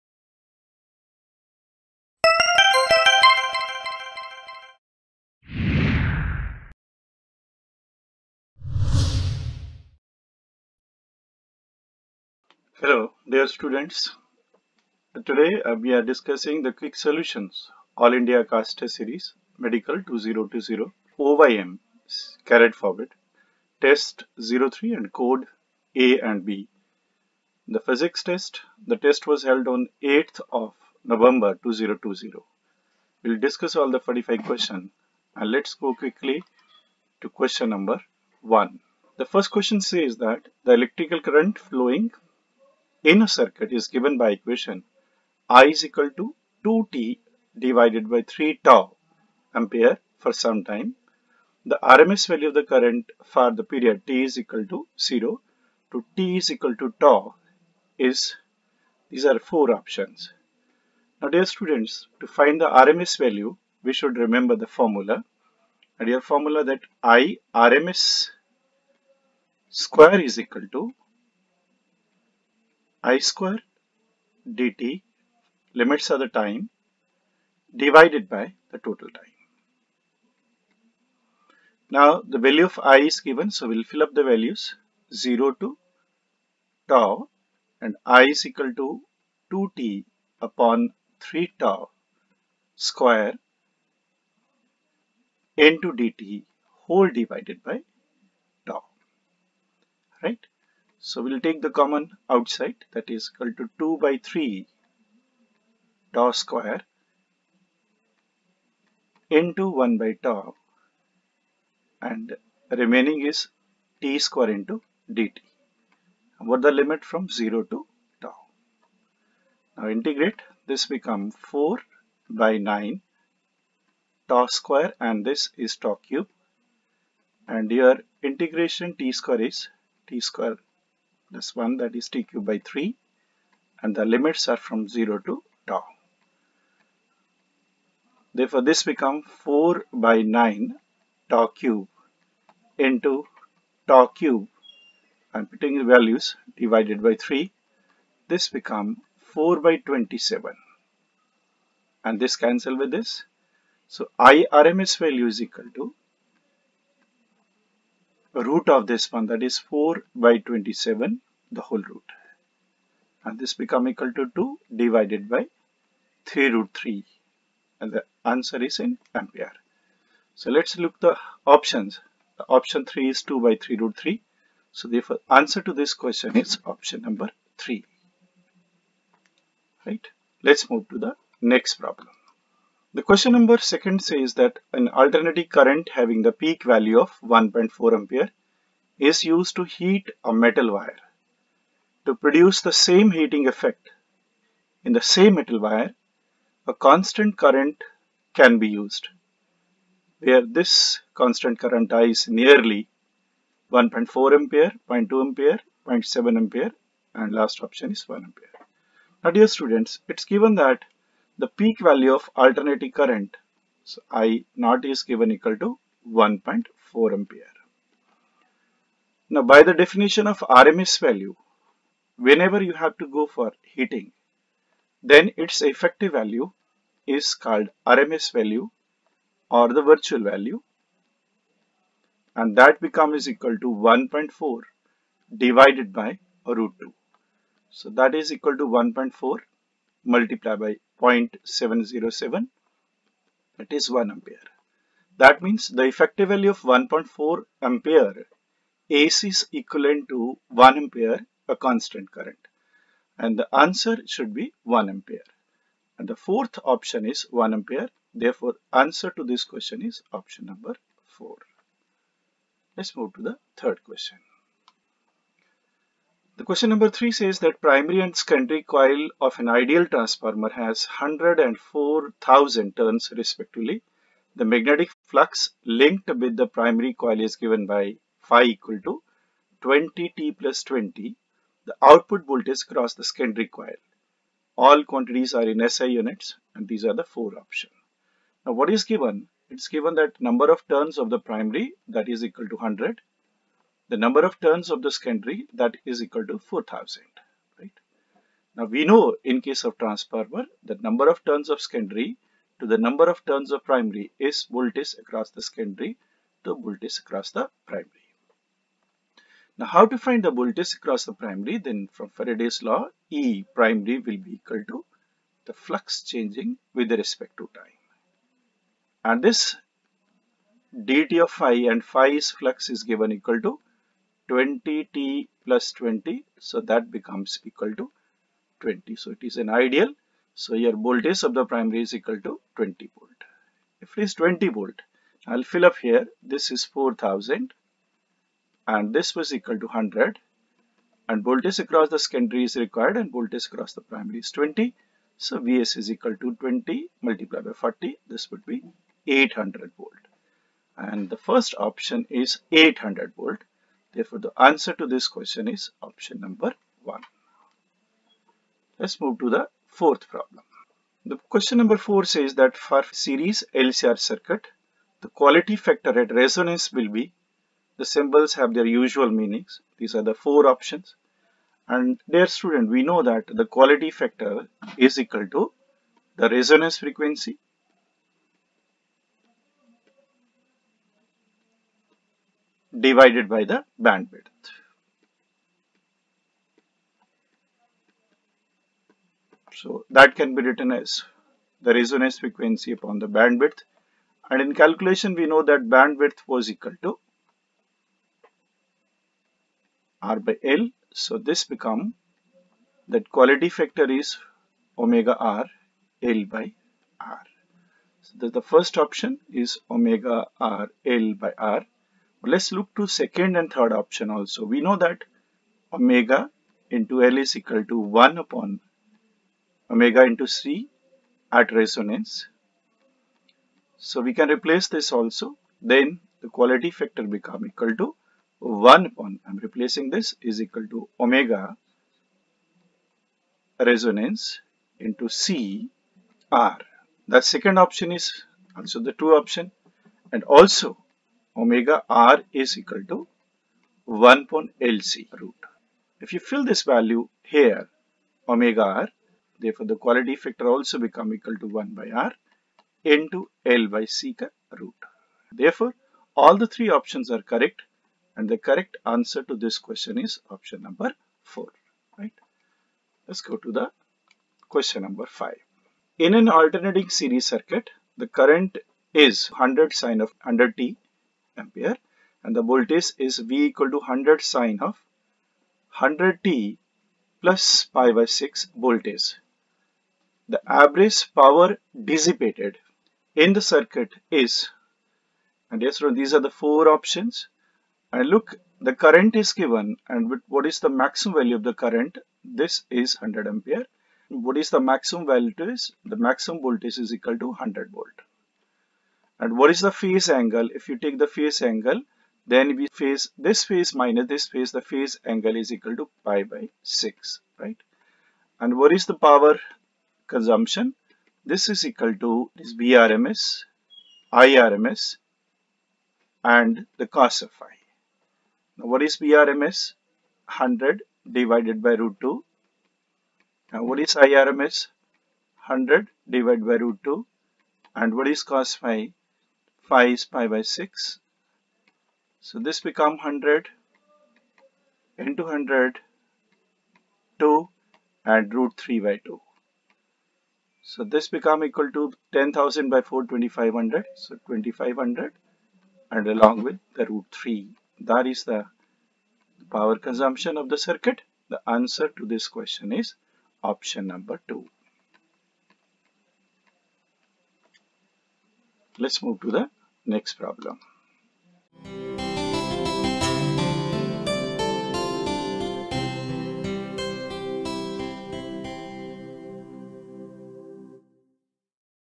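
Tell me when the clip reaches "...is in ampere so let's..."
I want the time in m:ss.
2:48.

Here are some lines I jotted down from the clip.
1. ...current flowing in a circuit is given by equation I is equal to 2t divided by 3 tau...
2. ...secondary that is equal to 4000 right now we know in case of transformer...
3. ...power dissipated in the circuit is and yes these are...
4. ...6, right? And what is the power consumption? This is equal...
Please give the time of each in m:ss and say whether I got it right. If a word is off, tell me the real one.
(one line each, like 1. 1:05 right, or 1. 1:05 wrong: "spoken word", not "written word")
1. 0:41 right
2. 4:54 right
3. 8:01 right
4. 8:26 right.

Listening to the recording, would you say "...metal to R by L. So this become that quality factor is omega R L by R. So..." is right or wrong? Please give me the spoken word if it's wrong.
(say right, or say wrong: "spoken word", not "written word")
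wrong: "equal", not "metal".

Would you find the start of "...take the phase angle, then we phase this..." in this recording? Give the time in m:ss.
8:20.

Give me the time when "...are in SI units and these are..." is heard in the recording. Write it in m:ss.
4:45.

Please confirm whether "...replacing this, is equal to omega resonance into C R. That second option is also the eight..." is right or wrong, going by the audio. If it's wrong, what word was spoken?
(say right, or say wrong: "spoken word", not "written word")
wrong: "two", not "eight".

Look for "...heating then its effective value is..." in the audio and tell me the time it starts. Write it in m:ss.
3:43.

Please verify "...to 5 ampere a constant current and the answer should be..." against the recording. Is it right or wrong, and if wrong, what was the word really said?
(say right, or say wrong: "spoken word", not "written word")
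wrong: "1", not "5".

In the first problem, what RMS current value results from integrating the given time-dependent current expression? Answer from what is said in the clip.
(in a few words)
2/(3√3) ampere.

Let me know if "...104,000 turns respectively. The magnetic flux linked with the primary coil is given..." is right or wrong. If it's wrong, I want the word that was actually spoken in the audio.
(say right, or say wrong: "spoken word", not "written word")
right.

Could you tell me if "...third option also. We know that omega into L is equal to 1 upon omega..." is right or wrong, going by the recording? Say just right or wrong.
right.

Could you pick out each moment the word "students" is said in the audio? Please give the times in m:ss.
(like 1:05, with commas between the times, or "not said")
0:13, 1:01, 3:29, 6:12.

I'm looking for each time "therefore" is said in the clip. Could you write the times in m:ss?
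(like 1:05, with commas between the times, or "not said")
2:18, 4:18, 5:53, 7:29, 7:35.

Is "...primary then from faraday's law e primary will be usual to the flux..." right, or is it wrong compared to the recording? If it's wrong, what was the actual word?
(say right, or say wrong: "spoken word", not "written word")
wrong: "equal", not "usual".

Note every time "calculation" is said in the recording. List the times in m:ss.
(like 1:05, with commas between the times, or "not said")
6:34.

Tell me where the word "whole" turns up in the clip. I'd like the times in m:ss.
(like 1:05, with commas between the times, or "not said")
1:36, 2:41.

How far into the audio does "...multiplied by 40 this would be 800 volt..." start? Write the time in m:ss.
5:47.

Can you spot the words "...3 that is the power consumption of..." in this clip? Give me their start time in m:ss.
9:07.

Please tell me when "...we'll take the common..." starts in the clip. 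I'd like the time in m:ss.
1:41.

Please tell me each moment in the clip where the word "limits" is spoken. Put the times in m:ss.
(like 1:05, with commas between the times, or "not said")
1:15, 1:56, 2:14.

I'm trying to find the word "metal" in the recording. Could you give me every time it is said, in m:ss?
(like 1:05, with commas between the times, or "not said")
3:10, 3:15.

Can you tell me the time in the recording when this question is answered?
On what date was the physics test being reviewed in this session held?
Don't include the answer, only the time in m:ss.
0:30.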